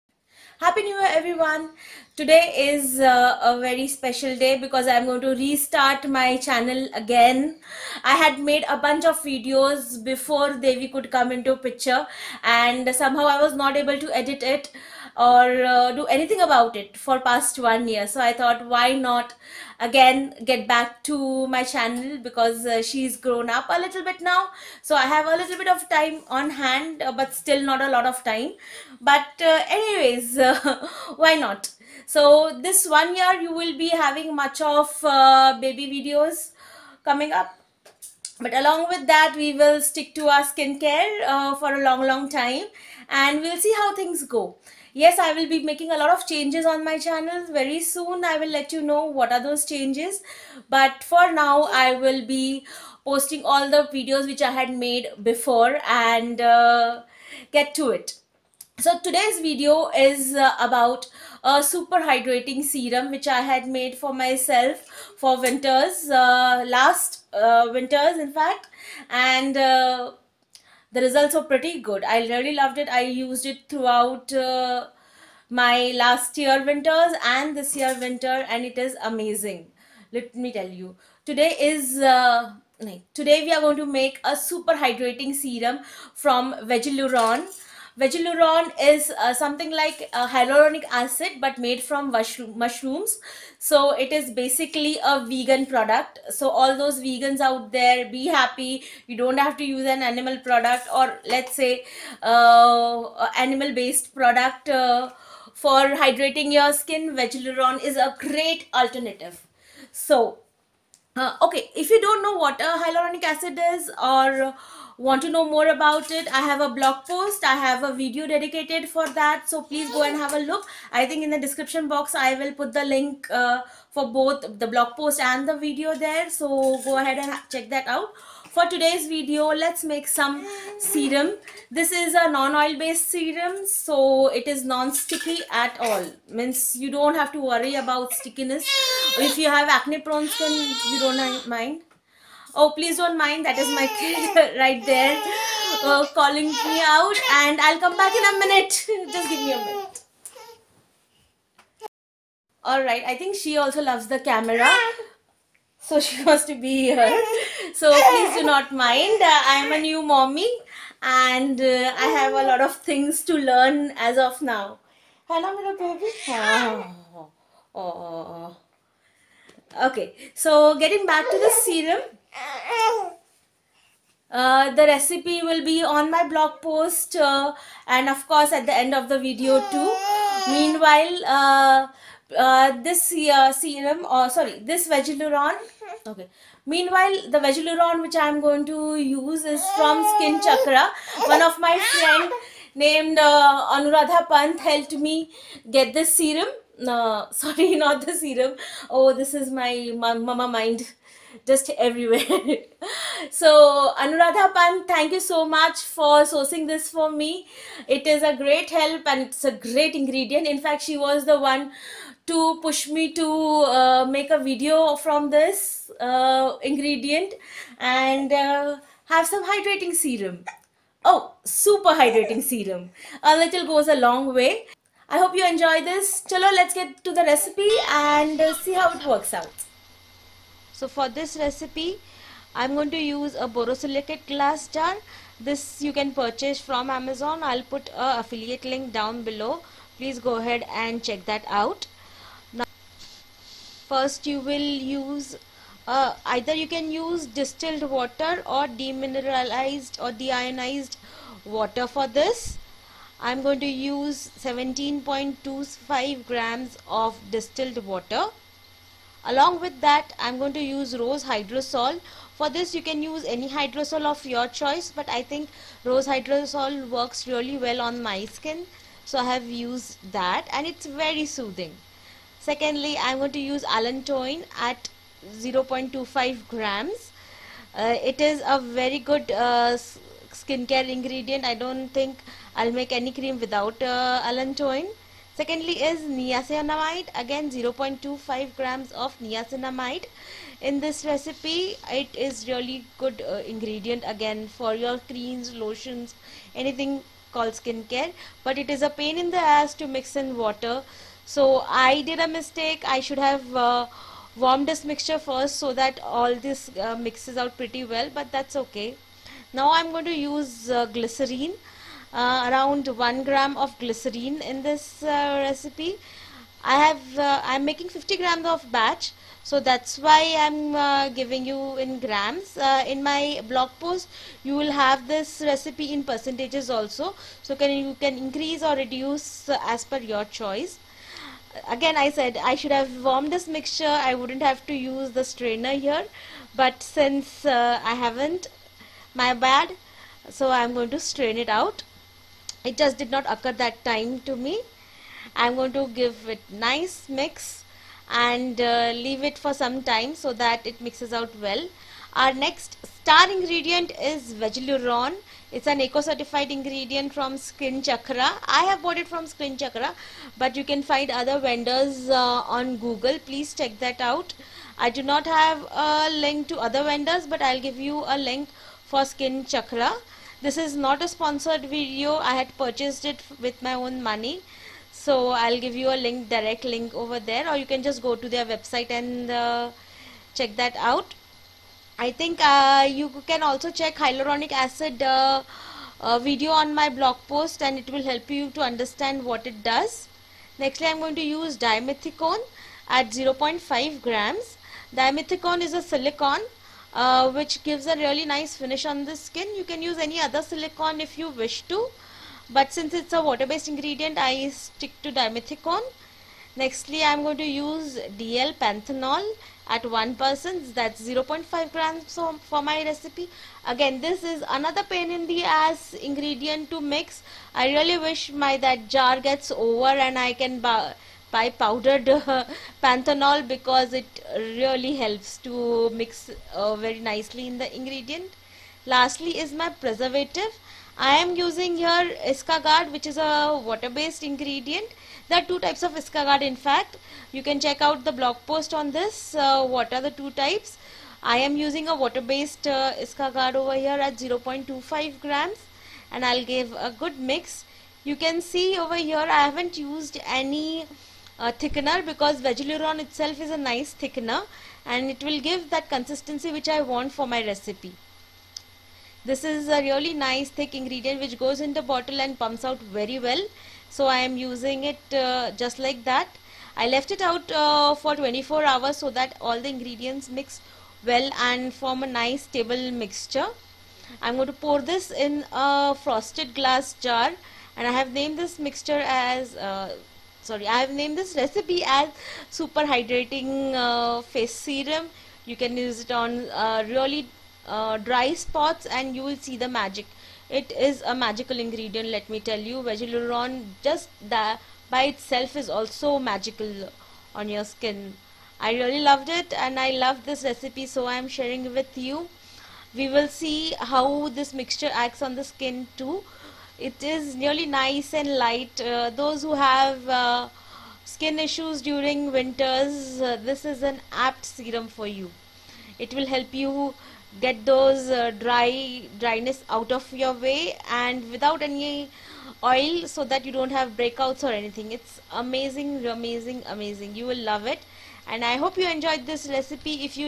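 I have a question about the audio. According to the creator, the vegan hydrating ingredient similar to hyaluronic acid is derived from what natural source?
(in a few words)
mushrooms.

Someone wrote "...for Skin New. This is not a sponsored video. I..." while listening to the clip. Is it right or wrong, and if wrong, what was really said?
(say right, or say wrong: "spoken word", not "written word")
wrong: "Chakra", not "New".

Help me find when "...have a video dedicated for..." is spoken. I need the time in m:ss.
1:57.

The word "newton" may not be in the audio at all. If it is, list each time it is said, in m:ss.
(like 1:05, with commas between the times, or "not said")
not said.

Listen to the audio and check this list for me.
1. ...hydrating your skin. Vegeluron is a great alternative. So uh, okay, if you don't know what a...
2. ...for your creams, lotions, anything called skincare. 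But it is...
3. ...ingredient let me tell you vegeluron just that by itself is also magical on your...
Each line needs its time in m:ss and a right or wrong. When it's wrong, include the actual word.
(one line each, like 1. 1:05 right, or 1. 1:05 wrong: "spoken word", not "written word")
1. 1:45 right
2. 4:54 right
3. 8:11 right.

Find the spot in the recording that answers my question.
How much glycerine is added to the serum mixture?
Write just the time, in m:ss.
5:12.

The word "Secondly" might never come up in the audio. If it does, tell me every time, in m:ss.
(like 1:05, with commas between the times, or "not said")
4:32, 4:45.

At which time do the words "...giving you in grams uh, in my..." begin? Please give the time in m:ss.
5:21.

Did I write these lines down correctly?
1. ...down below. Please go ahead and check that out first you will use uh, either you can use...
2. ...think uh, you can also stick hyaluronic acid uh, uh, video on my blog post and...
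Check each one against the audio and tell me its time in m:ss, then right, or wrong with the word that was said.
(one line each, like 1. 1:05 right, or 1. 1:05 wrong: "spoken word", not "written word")
1. 3:58 right
2. 6:22 wrong: "check", not "stick".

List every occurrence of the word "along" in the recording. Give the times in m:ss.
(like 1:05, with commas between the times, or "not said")
0:38, 4:19.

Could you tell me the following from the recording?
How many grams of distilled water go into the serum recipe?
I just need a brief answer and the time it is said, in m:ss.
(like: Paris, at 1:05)
17.25 grams, at 4:14.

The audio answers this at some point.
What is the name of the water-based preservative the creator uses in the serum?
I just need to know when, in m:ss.
7:12.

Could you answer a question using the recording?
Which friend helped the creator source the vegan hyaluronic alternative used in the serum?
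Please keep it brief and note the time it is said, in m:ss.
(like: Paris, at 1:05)
Anuradha Pant, at 3:13.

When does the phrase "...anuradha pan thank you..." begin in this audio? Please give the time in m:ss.
3:24.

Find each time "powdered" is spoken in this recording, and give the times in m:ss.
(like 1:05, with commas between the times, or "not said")
7:01.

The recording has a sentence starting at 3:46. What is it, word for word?
Chalo, let's get to the recipe and uh, see how it works out.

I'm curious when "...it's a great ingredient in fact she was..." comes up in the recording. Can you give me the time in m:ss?
3:29.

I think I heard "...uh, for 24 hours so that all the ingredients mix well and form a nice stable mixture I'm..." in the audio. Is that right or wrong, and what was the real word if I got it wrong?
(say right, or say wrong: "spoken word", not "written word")
right.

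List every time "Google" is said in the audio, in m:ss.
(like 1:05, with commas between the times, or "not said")
6:02.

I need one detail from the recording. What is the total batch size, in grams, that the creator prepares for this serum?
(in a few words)
50 grams.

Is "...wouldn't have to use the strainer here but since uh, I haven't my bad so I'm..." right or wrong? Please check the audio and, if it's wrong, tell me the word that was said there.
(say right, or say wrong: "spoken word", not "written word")
right.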